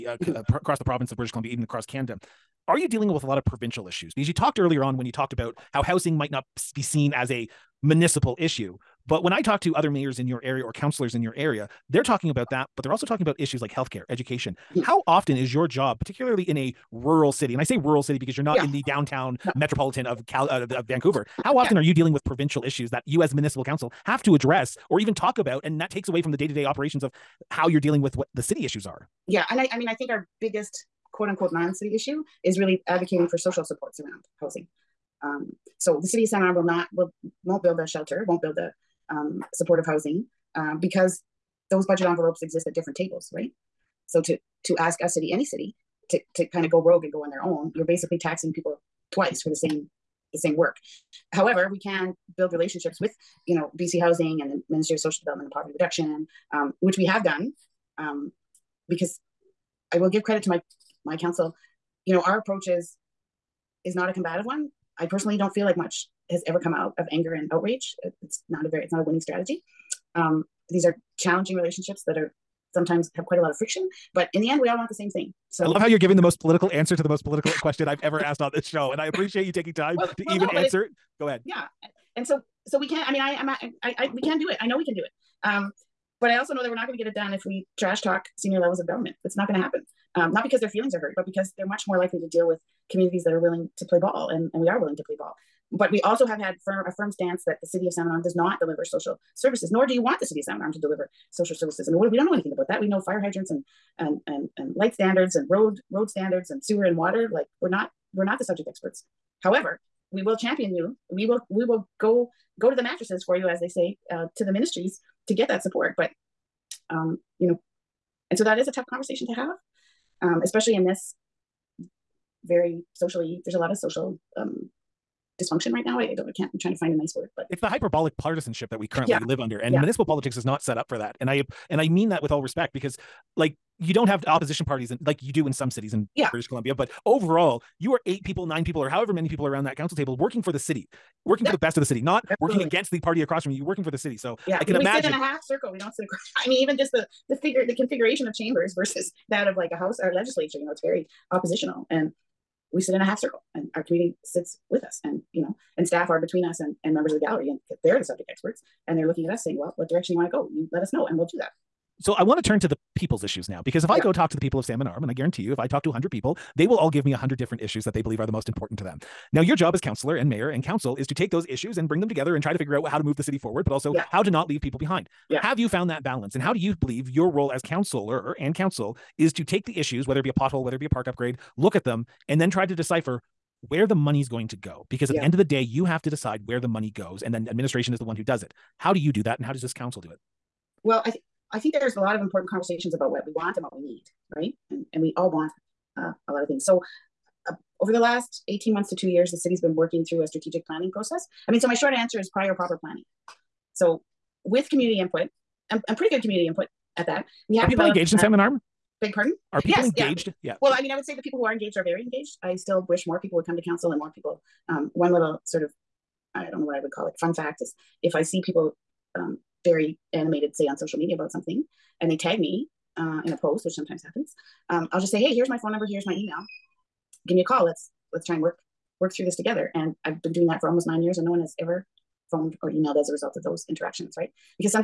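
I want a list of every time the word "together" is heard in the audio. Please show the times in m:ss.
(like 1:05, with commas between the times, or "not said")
2:52, 3:49.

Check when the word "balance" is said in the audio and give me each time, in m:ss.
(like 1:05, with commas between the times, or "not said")
2:56.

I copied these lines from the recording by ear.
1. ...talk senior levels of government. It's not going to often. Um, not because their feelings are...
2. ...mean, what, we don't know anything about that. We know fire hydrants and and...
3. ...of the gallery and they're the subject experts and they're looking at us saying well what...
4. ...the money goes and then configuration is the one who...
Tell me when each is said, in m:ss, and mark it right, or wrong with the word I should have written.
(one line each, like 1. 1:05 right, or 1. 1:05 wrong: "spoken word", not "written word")
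1. 1:28 wrong: "happen", not "often"
2. 1:41 right
3. 2:37 right
4. 3:06 wrong: "administration", not "configuration".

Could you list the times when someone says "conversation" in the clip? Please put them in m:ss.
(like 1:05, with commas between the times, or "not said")
1:58, 3:12.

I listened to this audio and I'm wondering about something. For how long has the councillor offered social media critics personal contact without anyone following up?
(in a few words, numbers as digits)
almost 9 years.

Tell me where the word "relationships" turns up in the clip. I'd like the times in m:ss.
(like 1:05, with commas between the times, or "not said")
0:52, 1:11.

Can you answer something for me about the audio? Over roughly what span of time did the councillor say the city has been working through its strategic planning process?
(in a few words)
18 months to 2 years.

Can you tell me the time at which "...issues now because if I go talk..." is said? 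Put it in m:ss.
2:43.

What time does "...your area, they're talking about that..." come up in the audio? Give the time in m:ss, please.
0:11.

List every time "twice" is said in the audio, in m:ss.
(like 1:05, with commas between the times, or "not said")
0:49.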